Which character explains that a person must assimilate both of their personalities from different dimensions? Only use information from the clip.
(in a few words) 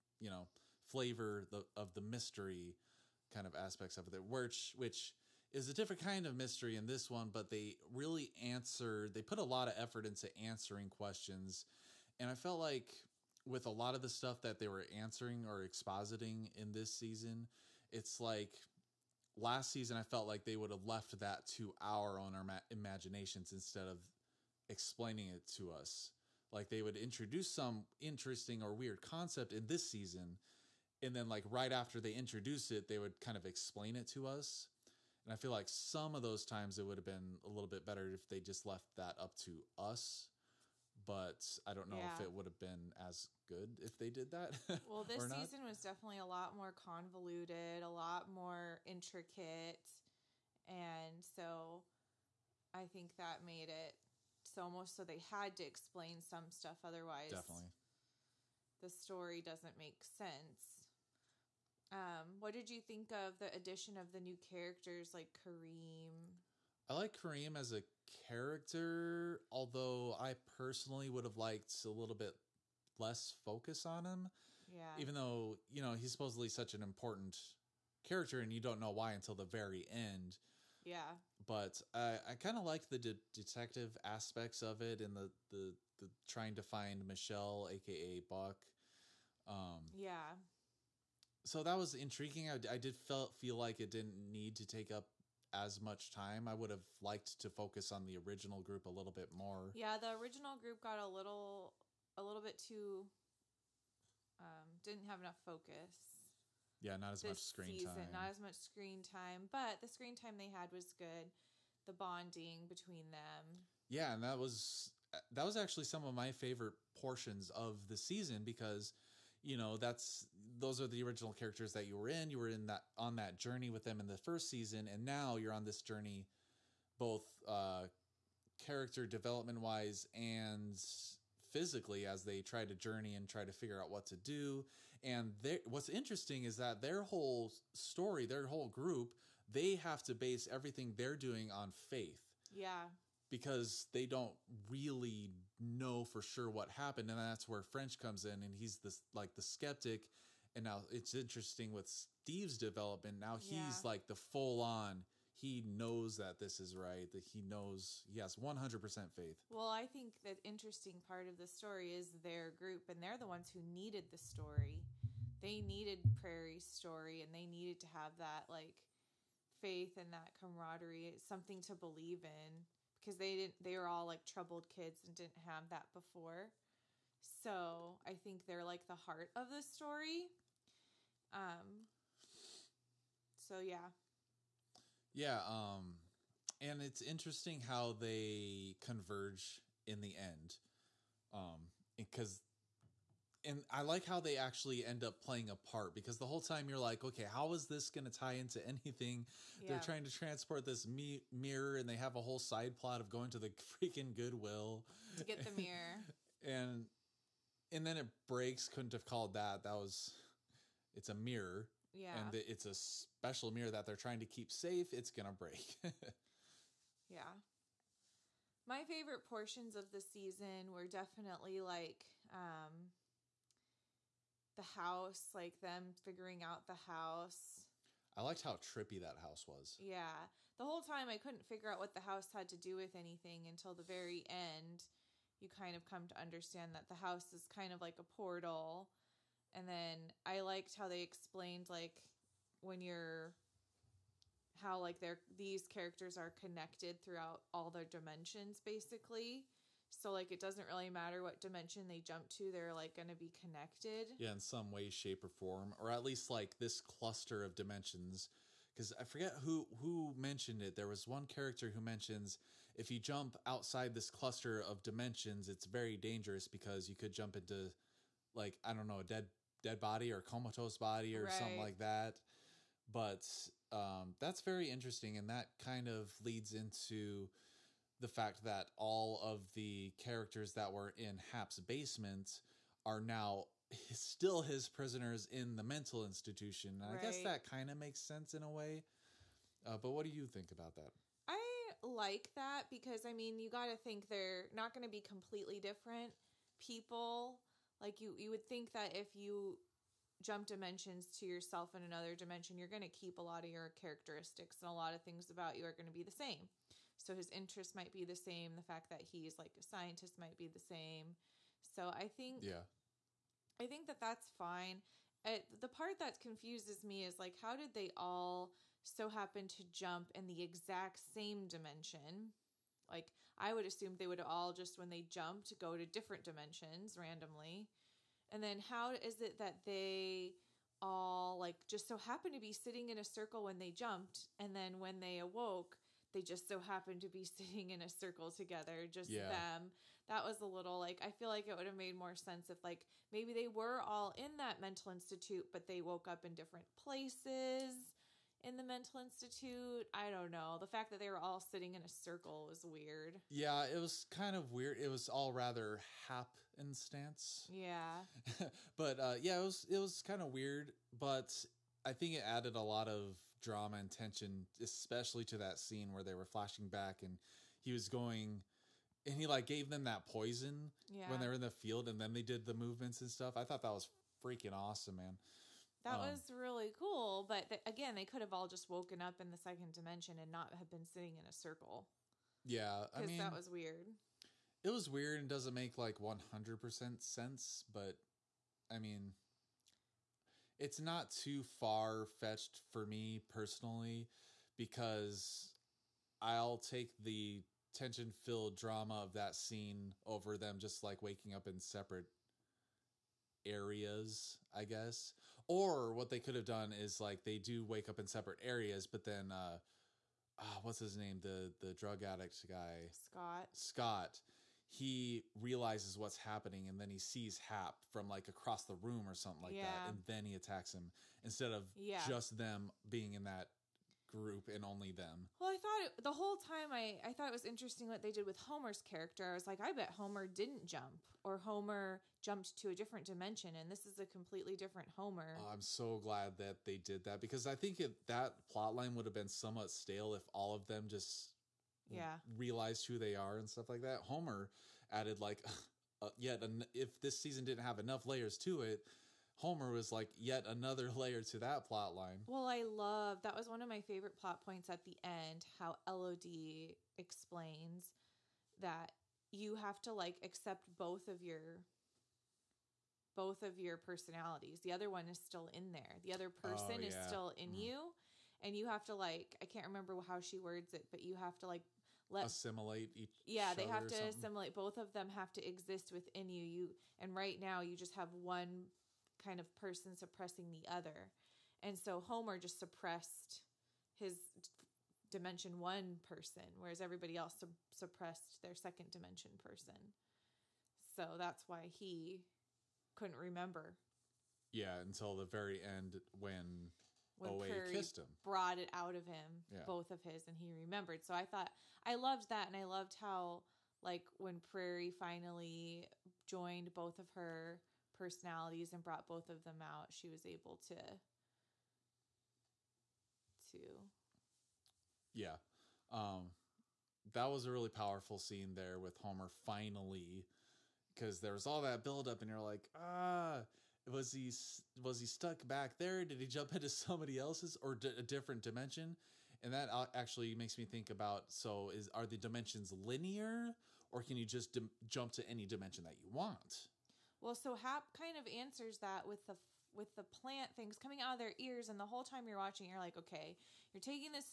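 Elodie.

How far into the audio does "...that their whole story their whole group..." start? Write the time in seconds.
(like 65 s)
136 s.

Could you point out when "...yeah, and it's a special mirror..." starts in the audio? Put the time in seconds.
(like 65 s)
211 s.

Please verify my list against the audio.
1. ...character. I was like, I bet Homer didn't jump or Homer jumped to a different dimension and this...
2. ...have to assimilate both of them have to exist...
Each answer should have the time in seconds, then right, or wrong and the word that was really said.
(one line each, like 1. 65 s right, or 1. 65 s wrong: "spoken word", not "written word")
1. 428 s right
2. 473 s right.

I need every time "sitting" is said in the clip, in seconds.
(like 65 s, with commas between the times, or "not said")
332 s, 337 s, 351 s, 380 s.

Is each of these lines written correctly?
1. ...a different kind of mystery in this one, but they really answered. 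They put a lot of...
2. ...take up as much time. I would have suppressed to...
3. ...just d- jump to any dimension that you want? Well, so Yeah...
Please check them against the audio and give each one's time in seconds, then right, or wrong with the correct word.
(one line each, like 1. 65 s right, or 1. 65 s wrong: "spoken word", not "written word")
1. 5 s right
2. 94 s wrong: "liked", not "suppressed"
3. 534 s wrong: "Hap", not "Yeah".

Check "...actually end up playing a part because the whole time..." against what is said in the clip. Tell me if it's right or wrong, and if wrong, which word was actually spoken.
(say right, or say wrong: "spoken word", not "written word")
right.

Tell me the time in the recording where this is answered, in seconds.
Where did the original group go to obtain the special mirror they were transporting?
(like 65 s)
204 s.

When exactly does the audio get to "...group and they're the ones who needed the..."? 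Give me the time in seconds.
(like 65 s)
162 s.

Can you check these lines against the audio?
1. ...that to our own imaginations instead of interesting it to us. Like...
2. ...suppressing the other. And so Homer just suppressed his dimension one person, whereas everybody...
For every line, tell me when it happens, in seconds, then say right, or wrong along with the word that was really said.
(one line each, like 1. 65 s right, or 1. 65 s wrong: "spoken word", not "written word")
1. 21 s wrong: "explaining", not "interesting"
2. 479 s right.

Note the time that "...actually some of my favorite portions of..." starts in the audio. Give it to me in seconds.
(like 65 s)
115 s.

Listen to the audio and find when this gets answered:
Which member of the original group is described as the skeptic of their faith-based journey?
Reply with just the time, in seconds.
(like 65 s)
147 s.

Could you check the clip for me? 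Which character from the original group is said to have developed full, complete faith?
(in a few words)
Steve.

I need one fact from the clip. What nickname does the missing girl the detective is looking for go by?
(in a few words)
Buck.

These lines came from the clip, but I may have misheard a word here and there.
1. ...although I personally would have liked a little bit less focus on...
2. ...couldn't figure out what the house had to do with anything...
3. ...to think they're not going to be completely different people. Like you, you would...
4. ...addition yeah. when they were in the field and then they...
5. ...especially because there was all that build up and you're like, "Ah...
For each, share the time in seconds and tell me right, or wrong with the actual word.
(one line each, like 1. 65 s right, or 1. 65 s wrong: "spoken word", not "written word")
1. 69 s right
2. 231 s right
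3. 293 s right
4. 370 s wrong: "poison", not "addition"
5. 519 s wrong: "finally", not "especially".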